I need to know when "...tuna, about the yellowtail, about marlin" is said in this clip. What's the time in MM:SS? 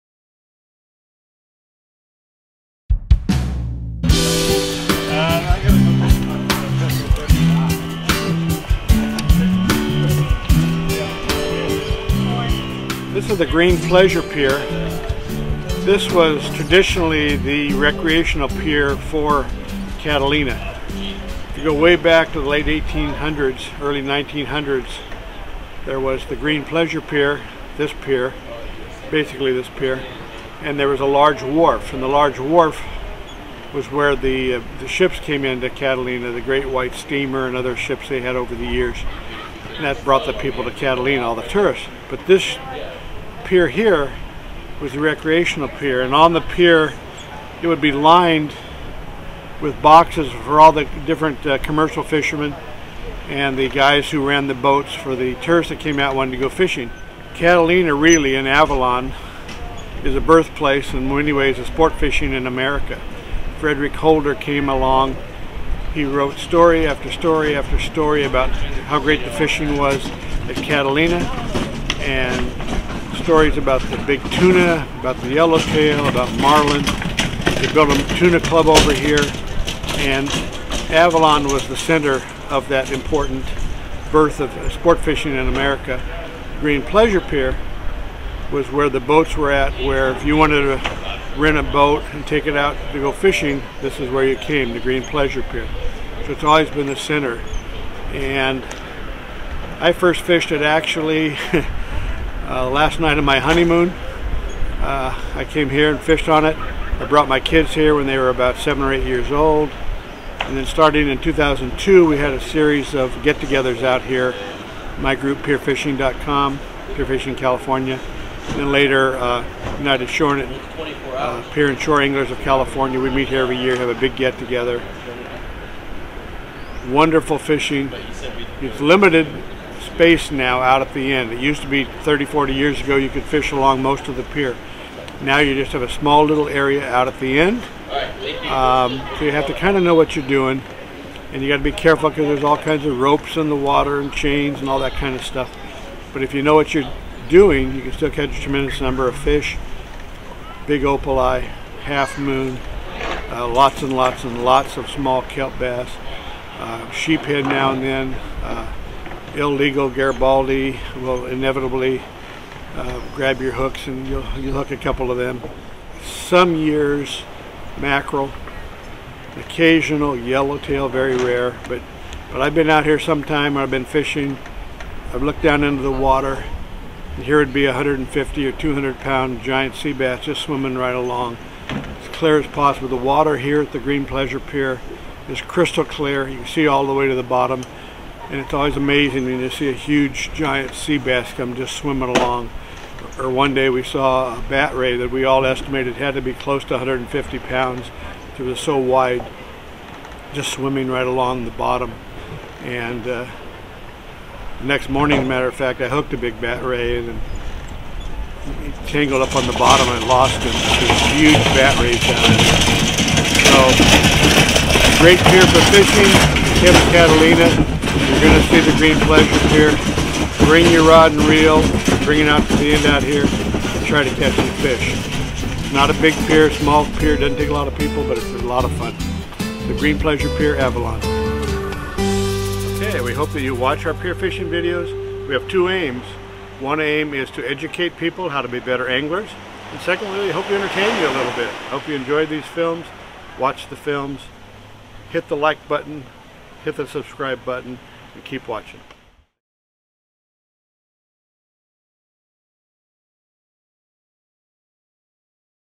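01:14.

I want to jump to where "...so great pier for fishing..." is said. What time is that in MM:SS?
03:33.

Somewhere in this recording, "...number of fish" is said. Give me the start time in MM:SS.
02:28.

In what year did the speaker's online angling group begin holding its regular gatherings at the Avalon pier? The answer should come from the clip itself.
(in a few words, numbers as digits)
2002.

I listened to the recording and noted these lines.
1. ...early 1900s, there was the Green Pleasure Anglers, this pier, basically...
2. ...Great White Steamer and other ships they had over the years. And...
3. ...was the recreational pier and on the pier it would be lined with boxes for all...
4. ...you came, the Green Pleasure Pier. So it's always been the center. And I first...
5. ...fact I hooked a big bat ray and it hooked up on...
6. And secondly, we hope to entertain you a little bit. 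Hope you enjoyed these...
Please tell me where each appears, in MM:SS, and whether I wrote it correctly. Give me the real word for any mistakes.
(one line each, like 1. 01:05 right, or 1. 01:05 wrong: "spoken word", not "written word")
1. 00:23 wrong: "Pier", not "Anglers"
2. 00:36 right
3. 00:44 right
4. 01:34 right
5. 03:25 wrong: "tangled", not "hooked"
6. 03:59 right.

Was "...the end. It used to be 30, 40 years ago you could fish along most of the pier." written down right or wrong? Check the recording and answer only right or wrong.
right.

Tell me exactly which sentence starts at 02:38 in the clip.
Uh, illegal Garibaldi will inevitably uh, grab your hooks and you'll, you'll hook a couple of them.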